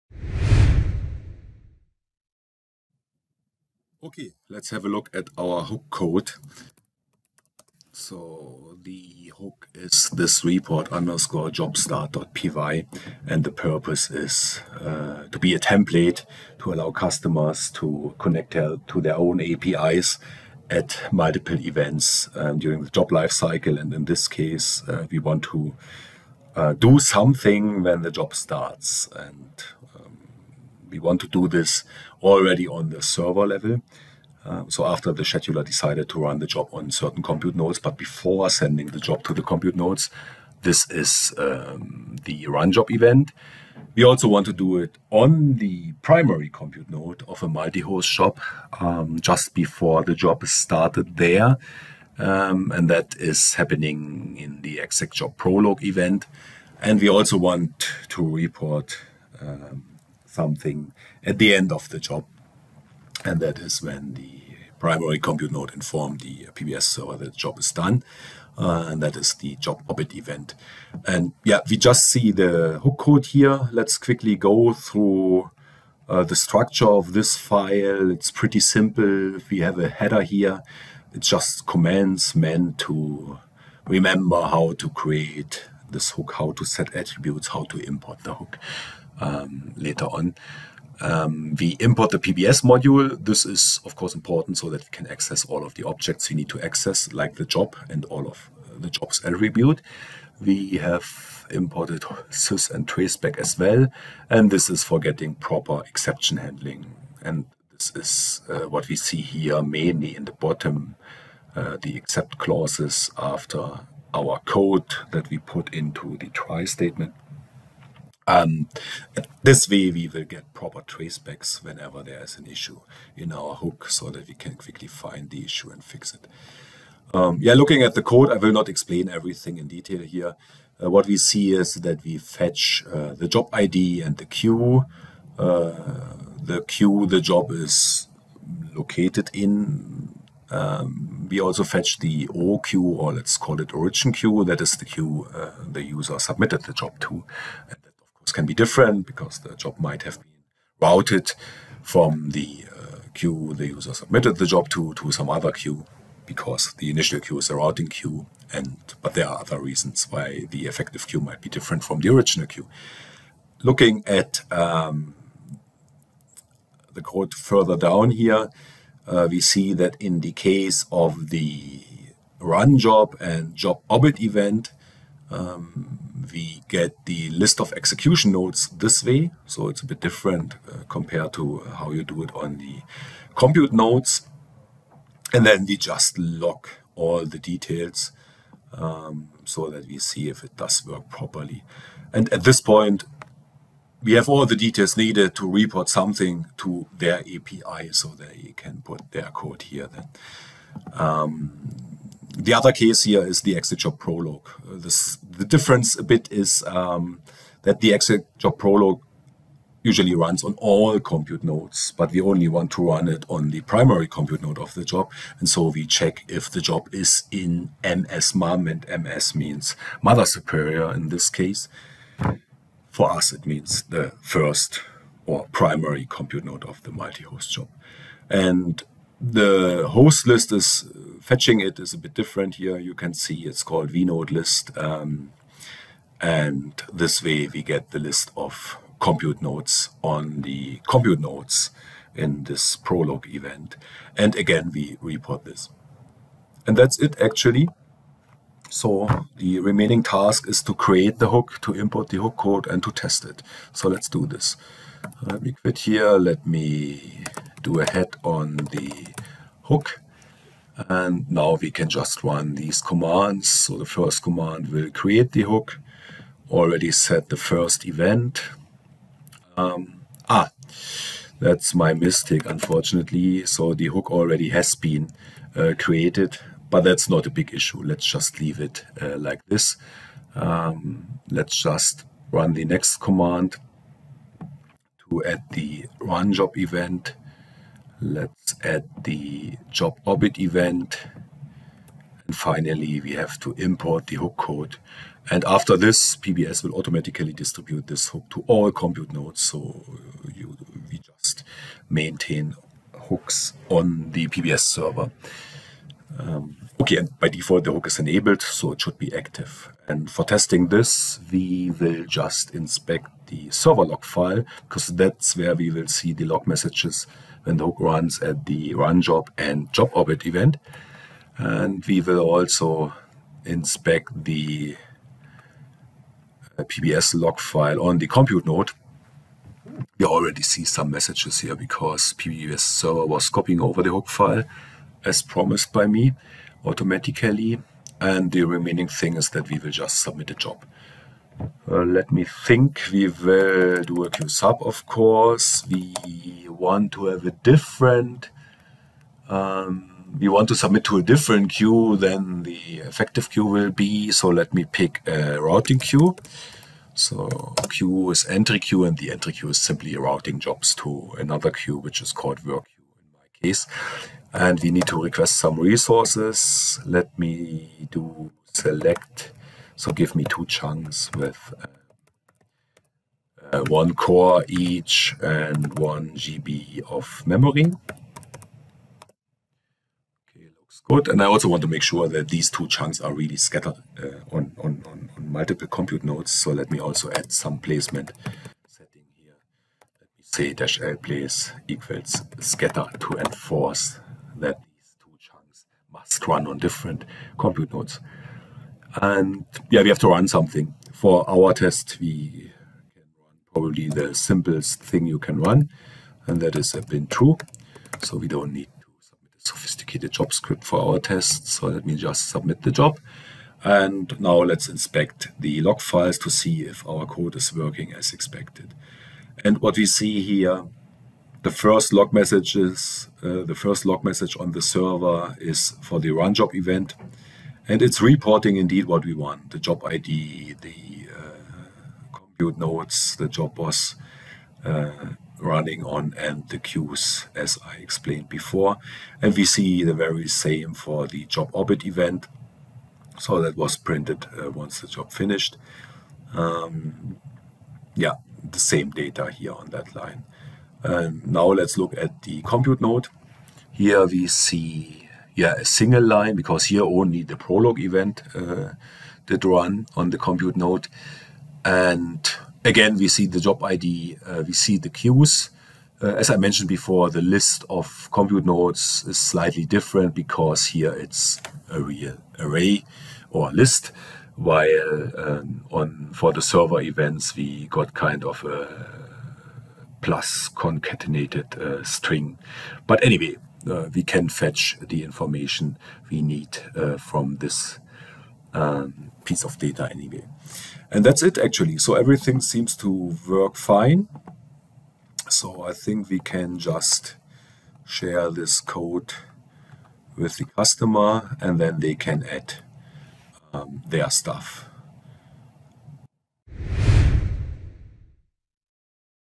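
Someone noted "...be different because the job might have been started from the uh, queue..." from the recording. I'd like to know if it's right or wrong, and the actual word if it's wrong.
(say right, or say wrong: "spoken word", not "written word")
wrong: "routed", not "started".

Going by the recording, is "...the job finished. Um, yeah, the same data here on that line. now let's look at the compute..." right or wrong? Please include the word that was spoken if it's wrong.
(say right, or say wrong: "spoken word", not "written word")
right.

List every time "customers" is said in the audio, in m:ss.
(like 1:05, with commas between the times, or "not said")
0:16, 8:20.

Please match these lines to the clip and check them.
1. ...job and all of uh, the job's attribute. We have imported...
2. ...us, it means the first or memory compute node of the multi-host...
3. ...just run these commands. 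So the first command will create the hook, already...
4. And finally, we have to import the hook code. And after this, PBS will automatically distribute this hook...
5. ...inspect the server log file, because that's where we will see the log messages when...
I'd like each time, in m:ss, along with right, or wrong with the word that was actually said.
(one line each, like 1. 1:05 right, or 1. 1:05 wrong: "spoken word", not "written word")
1. 1:37 right
2. 3:43 wrong: "primary", not "memory"
3. 4:21 right
4. 4:52 right
5. 5:12 right.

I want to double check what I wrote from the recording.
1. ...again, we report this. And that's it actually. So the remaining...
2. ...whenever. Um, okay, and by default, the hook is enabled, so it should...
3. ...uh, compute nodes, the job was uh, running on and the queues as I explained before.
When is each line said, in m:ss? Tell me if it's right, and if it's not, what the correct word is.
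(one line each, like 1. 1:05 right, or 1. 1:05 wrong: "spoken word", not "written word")
1. 4:04 right
2. 5:04 wrong: "server", not "whenever"
3. 7:11 right.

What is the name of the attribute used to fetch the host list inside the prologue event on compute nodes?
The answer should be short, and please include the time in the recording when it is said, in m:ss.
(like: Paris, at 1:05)
vnode list, at 3:53.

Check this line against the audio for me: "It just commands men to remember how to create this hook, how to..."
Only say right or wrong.
right.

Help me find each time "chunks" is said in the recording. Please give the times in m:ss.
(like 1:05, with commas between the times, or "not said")
6:10, 6:22, 6:35.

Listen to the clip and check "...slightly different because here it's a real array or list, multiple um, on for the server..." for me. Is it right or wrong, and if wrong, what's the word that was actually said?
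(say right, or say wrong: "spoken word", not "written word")
wrong: "while", not "multiple".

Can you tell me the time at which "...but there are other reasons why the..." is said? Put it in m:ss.
2:39.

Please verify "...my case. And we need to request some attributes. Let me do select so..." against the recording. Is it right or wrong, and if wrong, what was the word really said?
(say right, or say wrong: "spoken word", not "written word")
wrong: "resources", not "attributes".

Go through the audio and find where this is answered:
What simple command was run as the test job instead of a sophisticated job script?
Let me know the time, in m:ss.
6:46.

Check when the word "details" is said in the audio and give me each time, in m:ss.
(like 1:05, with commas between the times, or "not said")
2:09, 3:07, 3:14.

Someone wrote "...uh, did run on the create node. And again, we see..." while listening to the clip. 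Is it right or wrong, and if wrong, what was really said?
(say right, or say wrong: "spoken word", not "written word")
wrong: "compute", not "create".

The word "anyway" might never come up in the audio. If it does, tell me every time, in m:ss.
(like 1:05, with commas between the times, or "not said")
8:03, 8:09.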